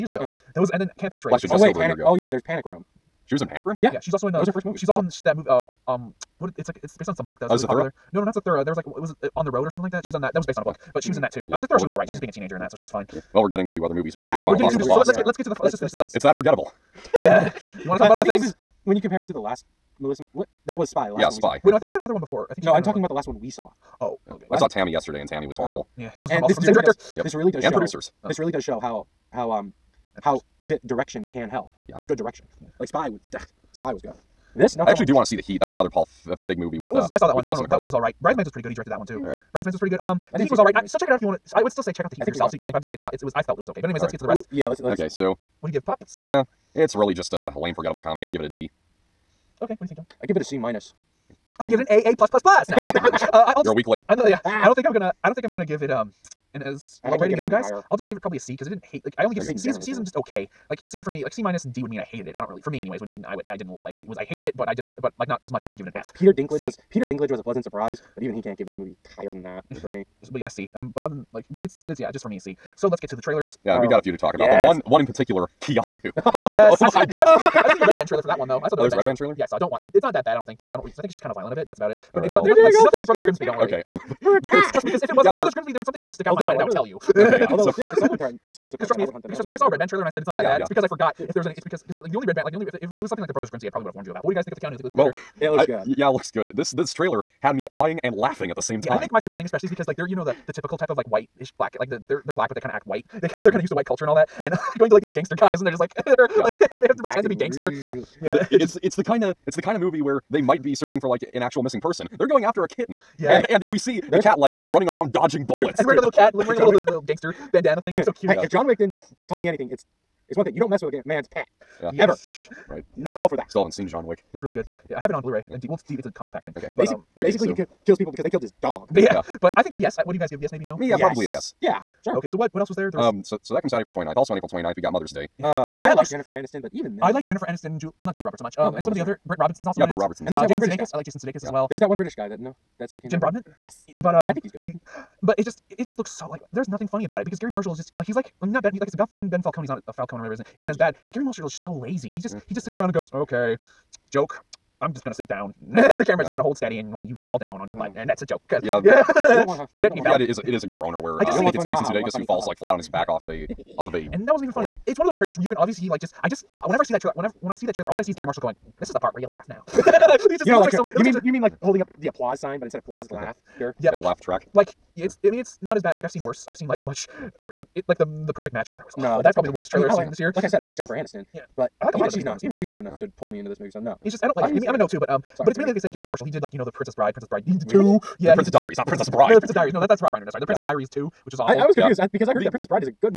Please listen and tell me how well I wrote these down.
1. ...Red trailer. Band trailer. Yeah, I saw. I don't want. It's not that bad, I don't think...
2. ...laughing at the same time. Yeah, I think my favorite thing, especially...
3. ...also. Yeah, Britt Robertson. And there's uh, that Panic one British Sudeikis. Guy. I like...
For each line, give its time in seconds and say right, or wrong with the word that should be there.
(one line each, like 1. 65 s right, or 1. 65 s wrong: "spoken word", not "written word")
1. 78 s right
2. 98 s right
3. 139 s wrong: "Jason", not "Panic".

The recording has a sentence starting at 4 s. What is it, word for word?
Uh, that was her first movie.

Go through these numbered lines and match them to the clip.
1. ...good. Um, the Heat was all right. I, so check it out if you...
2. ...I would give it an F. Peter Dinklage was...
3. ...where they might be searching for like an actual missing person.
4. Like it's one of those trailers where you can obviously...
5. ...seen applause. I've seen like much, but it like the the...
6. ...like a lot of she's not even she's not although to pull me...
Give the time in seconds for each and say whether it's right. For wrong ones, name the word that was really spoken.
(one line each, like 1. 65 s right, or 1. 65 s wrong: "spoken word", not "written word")
1. 39 s right
2. 65 s right
3. 110 s right
4. 164 s right
5. 176 s wrong: "worse", not "applause"
6. 181 s wrong: "enough", not "although".